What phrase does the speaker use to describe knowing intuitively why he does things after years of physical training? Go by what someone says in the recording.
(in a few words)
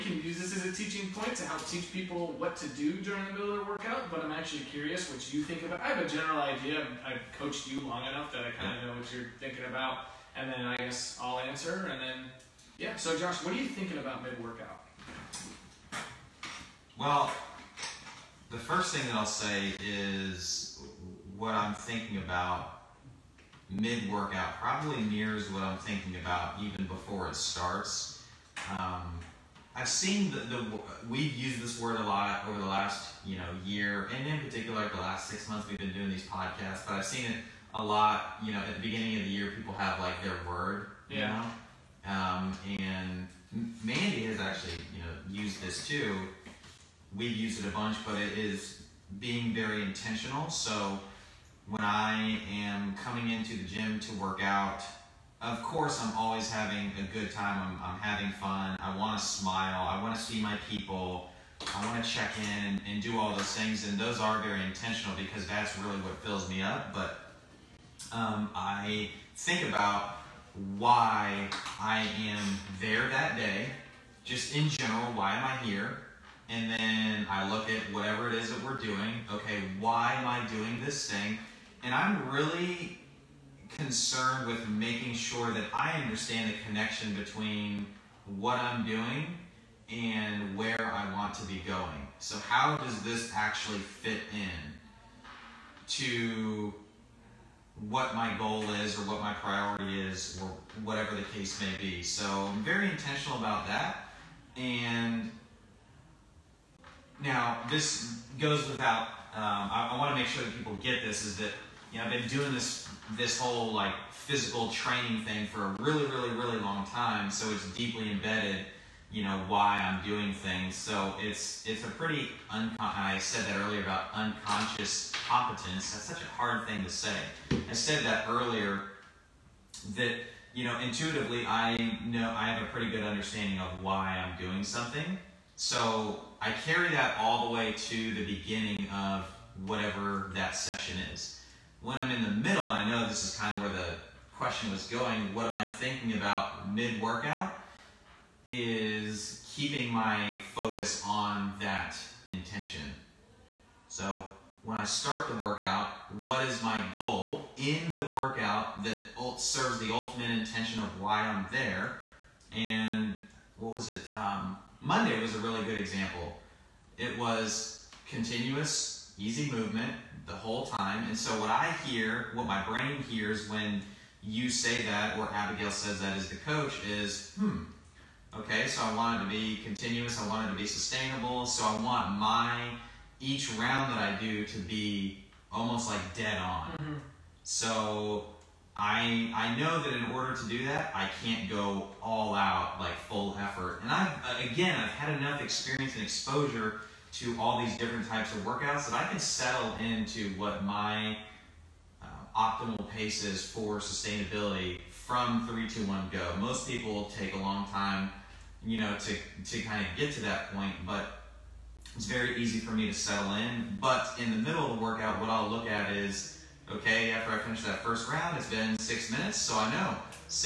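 unconscious competence.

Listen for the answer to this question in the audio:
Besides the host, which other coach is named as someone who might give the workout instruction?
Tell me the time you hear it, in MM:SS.
02:55.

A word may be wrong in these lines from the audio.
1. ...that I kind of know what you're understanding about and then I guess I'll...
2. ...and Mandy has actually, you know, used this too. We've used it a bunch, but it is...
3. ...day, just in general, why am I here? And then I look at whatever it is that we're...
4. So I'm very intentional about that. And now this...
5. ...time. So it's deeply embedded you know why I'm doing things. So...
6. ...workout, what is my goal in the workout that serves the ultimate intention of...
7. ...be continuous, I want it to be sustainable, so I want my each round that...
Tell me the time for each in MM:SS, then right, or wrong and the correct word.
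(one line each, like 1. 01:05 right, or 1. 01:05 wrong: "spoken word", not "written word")
1. 00:08 wrong: "thinking", not "understanding"
2. 00:42 right
3. 01:13 right
4. 01:42 right
5. 01:56 right
6. 02:35 right
7. 02:59 right.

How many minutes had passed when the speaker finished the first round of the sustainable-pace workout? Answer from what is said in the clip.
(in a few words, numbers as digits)
6.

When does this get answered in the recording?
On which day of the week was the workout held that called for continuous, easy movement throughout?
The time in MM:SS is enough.
02:44.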